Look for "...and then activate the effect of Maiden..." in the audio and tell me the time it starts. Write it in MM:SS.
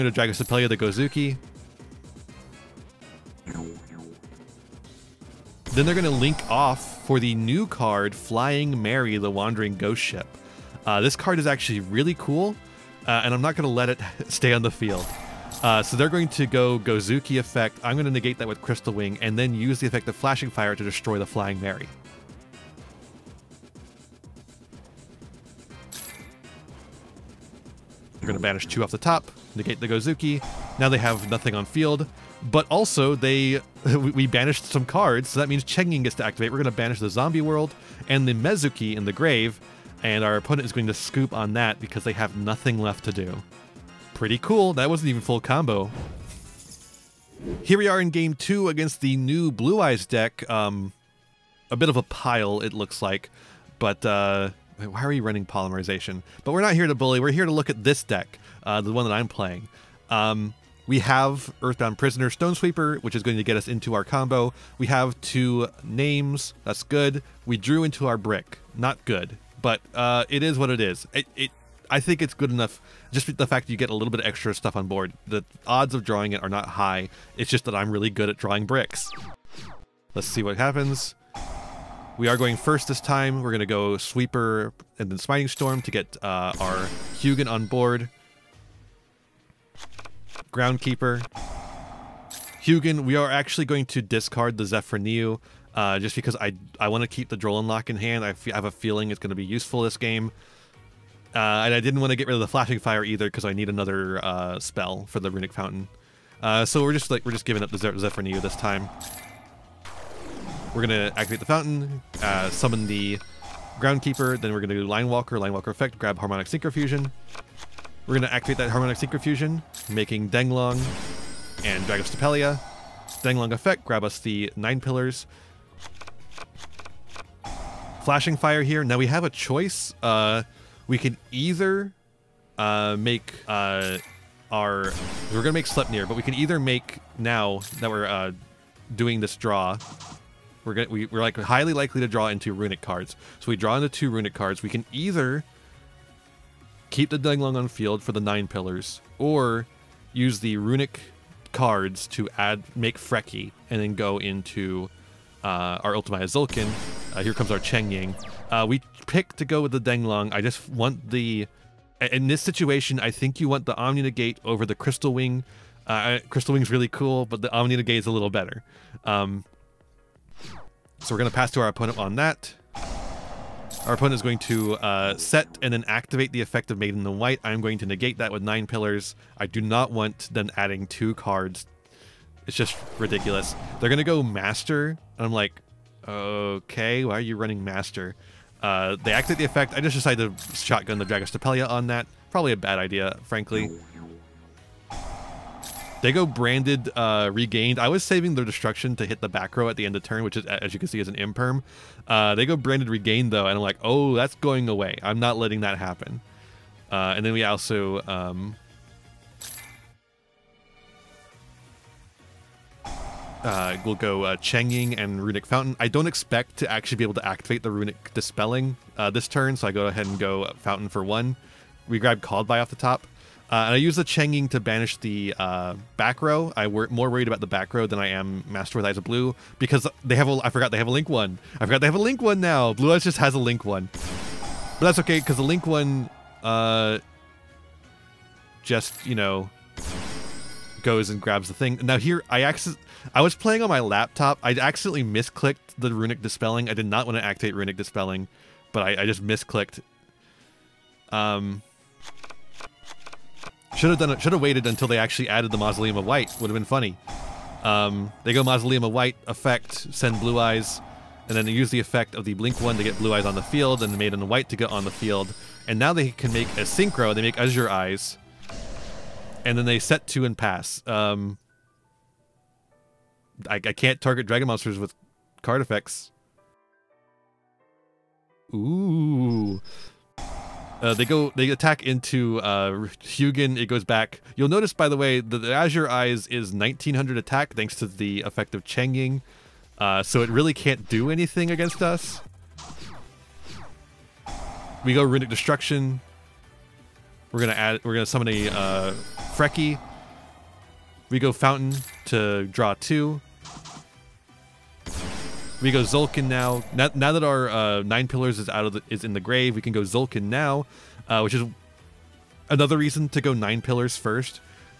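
02:55.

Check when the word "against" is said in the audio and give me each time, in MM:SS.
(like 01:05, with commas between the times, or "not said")
00:48, 04:51.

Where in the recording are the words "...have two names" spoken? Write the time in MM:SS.
01:04.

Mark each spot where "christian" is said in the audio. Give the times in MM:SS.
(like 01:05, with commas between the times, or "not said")
not said.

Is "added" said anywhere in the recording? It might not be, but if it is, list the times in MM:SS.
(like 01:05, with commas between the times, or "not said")
04:15.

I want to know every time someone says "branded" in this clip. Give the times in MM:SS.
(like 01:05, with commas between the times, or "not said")
03:16, 03:22.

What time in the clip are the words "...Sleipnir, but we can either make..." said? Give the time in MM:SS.
02:15.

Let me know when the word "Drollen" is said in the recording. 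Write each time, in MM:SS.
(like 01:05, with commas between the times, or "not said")
01:37.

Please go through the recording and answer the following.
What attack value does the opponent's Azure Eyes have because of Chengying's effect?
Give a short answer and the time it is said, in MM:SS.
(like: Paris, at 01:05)
1900, at 04:46.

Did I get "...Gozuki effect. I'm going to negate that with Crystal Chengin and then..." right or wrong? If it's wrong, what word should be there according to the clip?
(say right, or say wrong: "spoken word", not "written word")
wrong: "Wing", not "Chengin".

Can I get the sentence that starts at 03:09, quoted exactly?
I just decided to shotgun the Dragostapelia on that.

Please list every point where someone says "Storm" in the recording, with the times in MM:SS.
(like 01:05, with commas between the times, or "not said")
01:25.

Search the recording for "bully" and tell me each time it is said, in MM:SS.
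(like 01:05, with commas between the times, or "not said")
00:56.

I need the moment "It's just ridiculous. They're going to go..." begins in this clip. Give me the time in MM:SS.
03:02.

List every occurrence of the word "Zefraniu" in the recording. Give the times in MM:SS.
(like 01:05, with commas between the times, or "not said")
01:34, 01:47.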